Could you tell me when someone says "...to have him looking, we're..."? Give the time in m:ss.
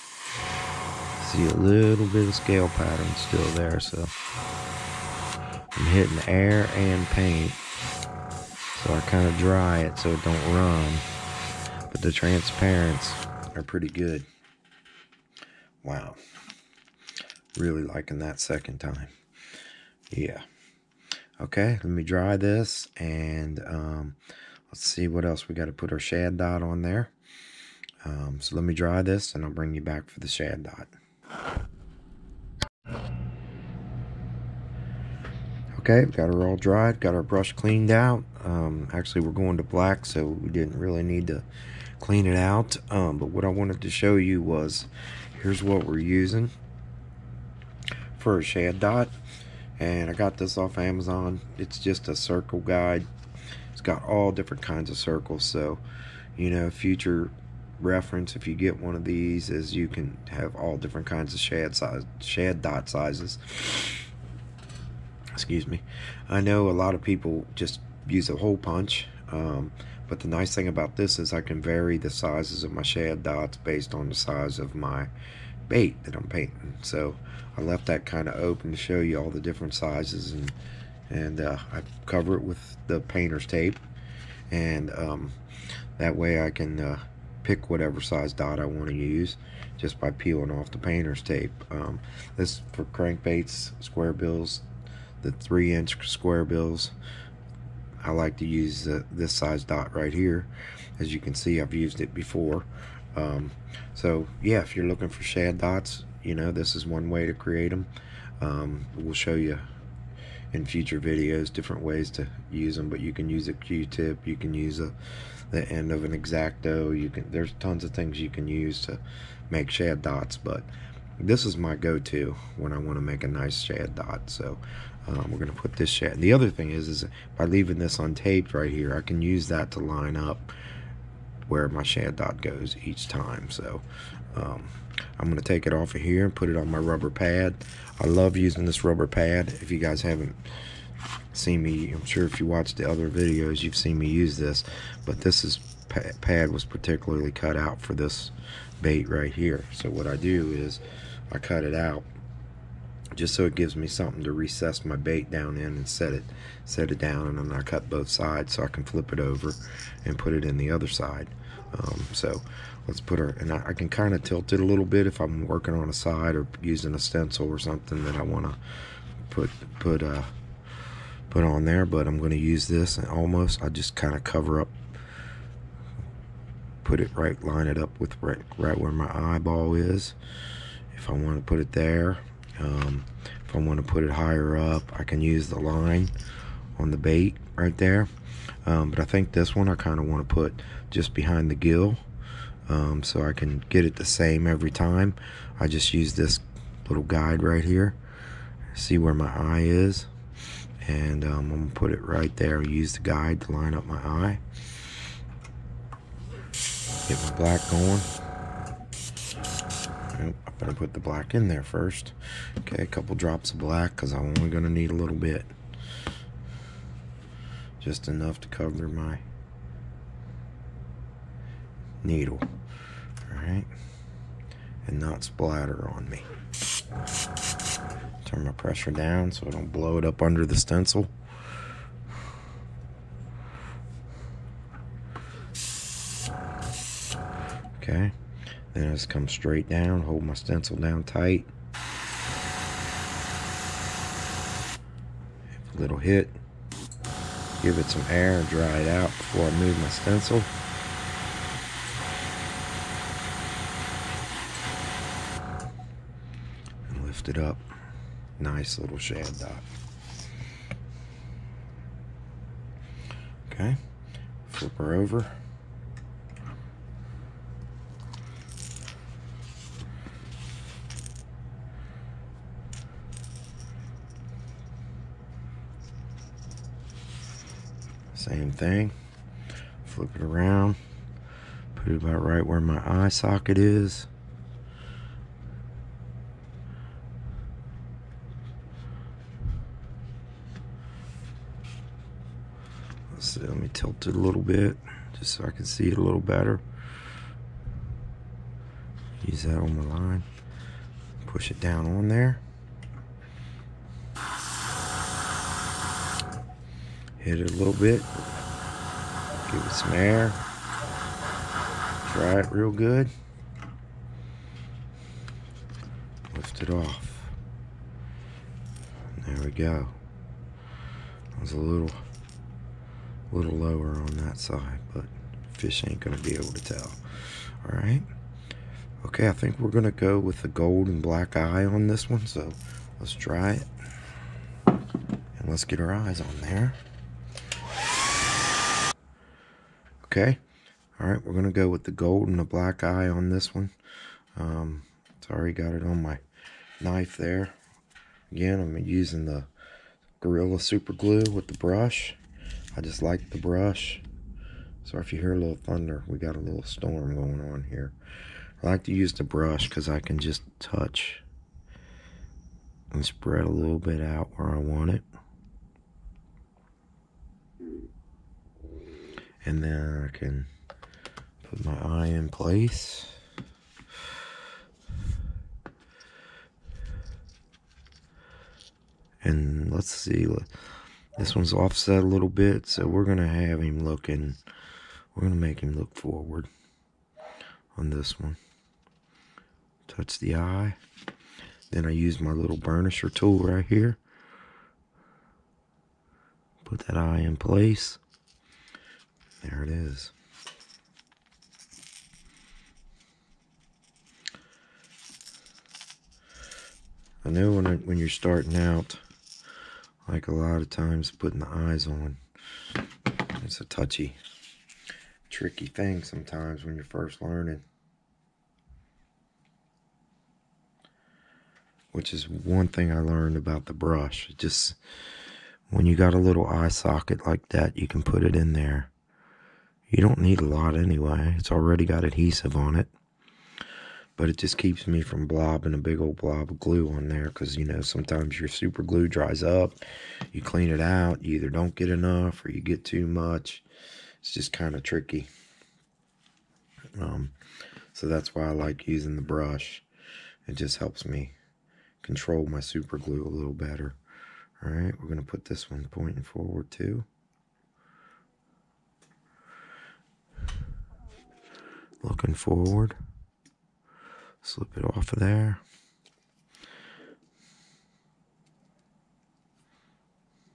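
6:23.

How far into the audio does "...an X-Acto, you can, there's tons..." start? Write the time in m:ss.
1:56.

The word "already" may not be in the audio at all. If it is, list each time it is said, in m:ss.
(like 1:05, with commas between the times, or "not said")
5:45, 7:11.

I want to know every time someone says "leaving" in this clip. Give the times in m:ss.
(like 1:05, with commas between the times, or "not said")
2:07.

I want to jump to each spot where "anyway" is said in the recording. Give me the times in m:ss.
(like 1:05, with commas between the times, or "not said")
7:10.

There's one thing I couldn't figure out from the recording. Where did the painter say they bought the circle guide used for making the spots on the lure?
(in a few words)
Amazon.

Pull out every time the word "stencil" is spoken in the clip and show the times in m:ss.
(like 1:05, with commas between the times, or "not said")
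2:46, 3:50, 4:00, 4:09.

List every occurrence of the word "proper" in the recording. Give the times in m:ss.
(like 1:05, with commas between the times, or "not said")
not said.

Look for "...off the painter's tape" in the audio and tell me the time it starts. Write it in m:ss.
1:30.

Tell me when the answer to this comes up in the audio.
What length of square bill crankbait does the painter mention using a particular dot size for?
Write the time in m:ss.
1:35.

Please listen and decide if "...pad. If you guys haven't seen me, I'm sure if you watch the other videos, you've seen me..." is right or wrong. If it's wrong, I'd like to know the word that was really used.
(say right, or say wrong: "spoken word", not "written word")
right.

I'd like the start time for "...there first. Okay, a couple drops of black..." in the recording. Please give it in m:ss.
3:31.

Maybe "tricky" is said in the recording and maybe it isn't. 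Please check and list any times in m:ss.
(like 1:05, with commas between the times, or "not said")
6:55, 7:24.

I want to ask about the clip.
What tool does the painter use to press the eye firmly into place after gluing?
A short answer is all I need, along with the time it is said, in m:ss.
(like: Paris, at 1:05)
Burnisher tool, at 6:32.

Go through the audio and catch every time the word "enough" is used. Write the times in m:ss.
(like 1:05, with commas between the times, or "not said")
3:38, 7:21.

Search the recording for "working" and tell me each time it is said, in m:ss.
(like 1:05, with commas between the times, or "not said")
2:45.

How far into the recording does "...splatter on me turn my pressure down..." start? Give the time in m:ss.
3:45.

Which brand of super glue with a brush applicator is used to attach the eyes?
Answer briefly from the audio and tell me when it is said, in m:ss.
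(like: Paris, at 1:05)
Gorilla, at 5:50.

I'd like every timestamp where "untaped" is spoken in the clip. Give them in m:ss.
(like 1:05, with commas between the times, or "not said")
2:07.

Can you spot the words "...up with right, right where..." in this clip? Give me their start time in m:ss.
2:57.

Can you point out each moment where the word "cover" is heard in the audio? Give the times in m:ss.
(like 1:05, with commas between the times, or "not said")
1:22, 2:54, 3:38.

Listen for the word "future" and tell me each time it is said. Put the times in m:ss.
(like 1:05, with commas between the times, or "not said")
0:56, 1:50.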